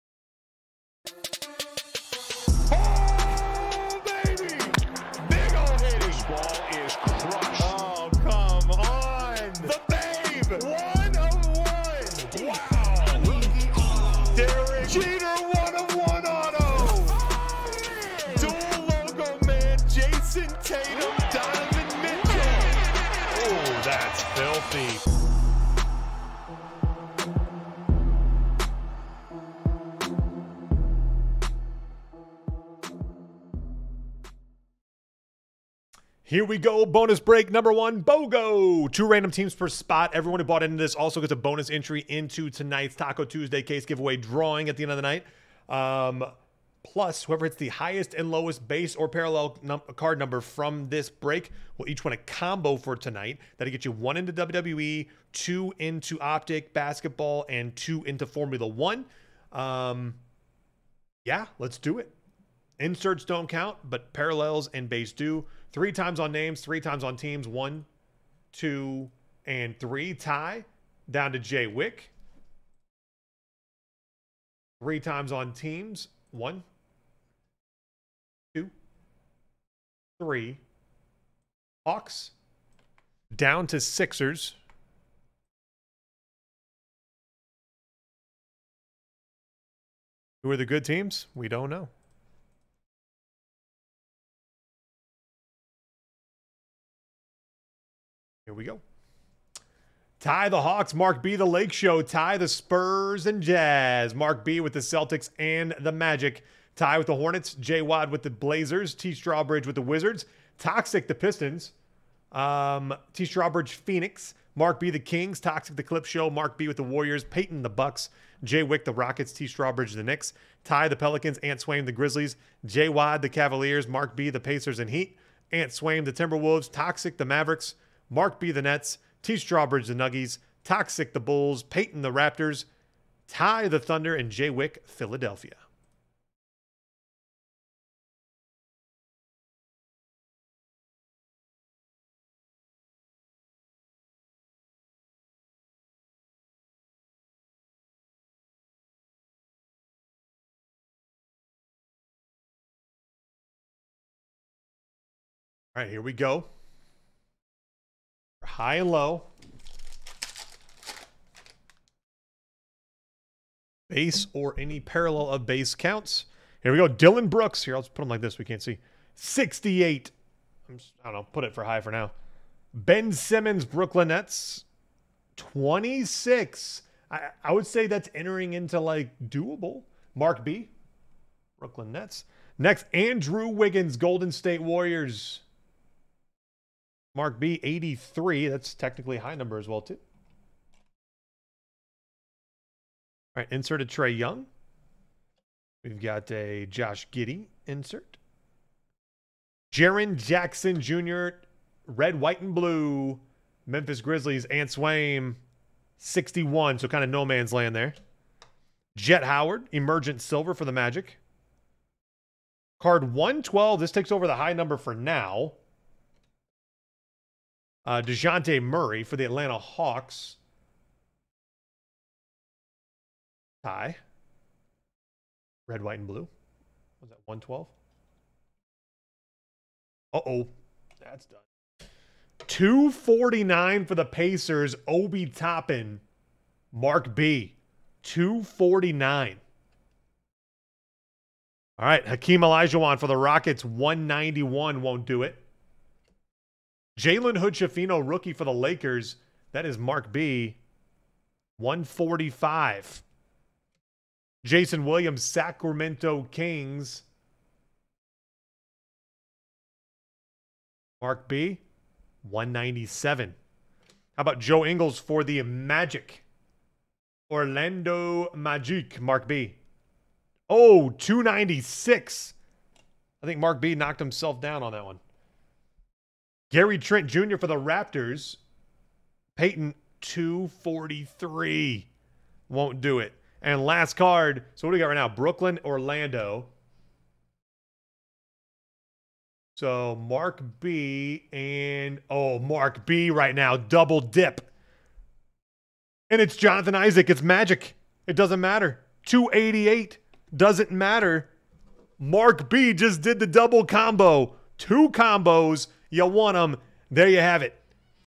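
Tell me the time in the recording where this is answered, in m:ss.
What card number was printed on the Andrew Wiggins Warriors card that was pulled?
3:07.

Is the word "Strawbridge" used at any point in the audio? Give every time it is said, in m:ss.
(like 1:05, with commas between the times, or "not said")
1:49, 1:53, 1:59, 2:09.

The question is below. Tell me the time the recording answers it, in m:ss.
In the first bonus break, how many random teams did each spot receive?
0:38.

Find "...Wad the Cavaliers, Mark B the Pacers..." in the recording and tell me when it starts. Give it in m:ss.
2:02.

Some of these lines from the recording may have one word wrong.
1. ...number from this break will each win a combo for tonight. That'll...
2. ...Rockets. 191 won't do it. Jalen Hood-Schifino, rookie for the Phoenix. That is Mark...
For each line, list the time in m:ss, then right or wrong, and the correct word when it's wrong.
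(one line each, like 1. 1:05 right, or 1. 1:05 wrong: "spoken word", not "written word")
1. 0:50 right
2. 4:03 wrong: "Lakers", not "Phoenix".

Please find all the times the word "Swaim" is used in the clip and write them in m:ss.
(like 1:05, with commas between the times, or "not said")
2:01, 2:05, 3:24.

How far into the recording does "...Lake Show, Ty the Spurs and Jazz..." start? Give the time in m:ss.
1:41.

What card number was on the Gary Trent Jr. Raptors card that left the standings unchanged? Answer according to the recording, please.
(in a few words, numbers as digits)
243.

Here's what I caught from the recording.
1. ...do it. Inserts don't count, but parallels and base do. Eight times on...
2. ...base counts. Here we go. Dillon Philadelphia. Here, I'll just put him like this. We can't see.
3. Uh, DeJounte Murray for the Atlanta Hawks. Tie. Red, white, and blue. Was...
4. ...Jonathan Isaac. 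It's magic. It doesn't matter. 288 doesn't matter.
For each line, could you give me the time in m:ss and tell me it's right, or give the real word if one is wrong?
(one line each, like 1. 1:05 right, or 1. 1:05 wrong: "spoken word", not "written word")
1. 1:01 wrong: "Three", not "Eight"
2. 2:45 wrong: "Brooks", not "Philadelphia"
3. 3:37 right
4. 4:56 right.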